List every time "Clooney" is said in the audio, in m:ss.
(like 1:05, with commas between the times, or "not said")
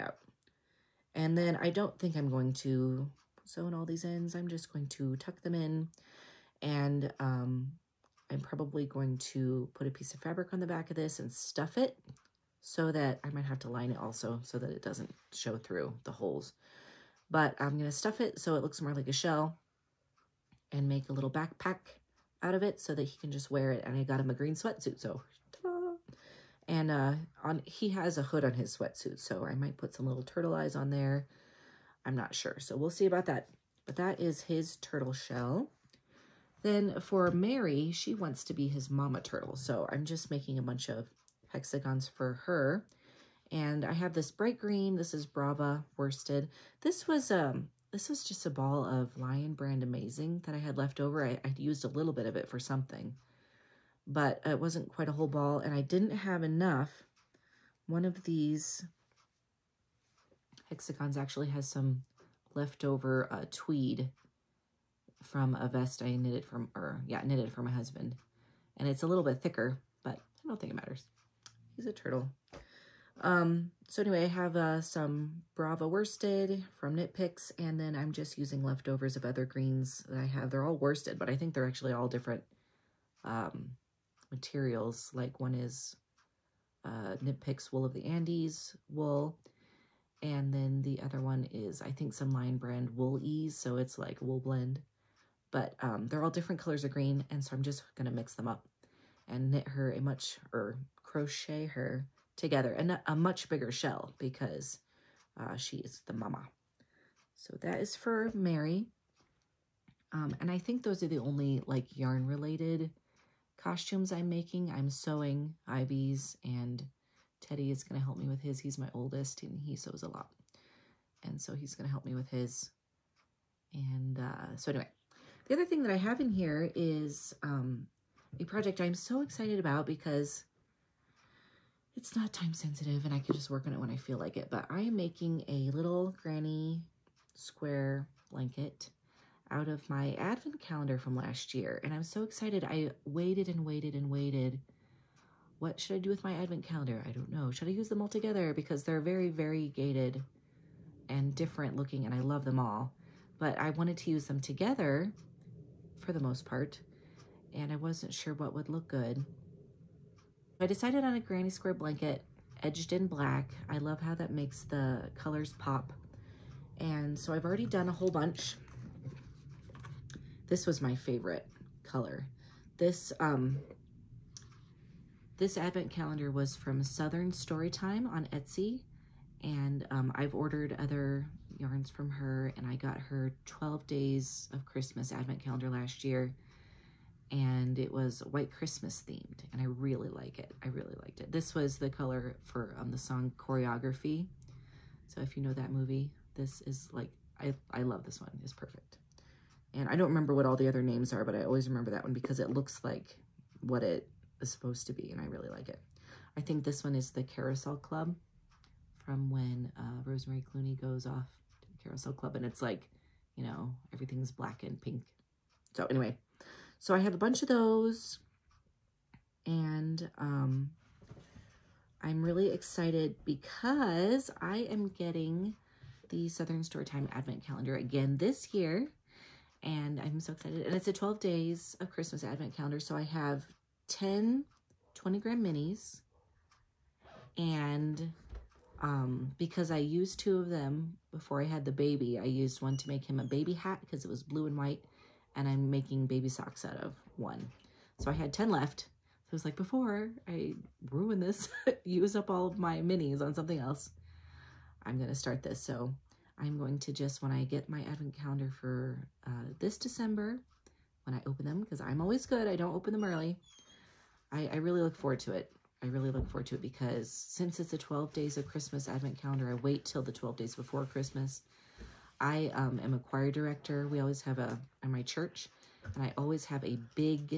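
3:30.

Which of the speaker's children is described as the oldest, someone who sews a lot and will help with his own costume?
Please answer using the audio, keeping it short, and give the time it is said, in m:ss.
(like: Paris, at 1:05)
Teddy, at 1:57.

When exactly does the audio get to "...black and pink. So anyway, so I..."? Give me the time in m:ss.
3:34.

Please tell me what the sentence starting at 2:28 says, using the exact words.
Because they're very variegated and different looking, and I love them all.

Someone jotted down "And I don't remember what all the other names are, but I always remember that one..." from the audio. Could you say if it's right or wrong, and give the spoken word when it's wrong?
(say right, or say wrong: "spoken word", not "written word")
right.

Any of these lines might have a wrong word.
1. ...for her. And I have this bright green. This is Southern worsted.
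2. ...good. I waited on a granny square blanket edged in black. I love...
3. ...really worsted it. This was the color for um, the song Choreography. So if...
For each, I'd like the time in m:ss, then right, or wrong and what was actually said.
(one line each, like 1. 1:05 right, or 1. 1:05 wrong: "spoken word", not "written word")
1. 0:42 wrong: "Brava", not "Southern"
2. 2:38 wrong: "decided", not "waited"
3. 3:10 wrong: "liked", not "worsted".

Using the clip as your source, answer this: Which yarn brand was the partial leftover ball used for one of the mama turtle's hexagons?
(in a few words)
Lion Brand Amazing.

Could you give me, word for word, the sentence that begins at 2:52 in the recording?
This, um, this advent calendar was from Southern Storytime on Etsy.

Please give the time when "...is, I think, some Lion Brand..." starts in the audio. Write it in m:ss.
1:31.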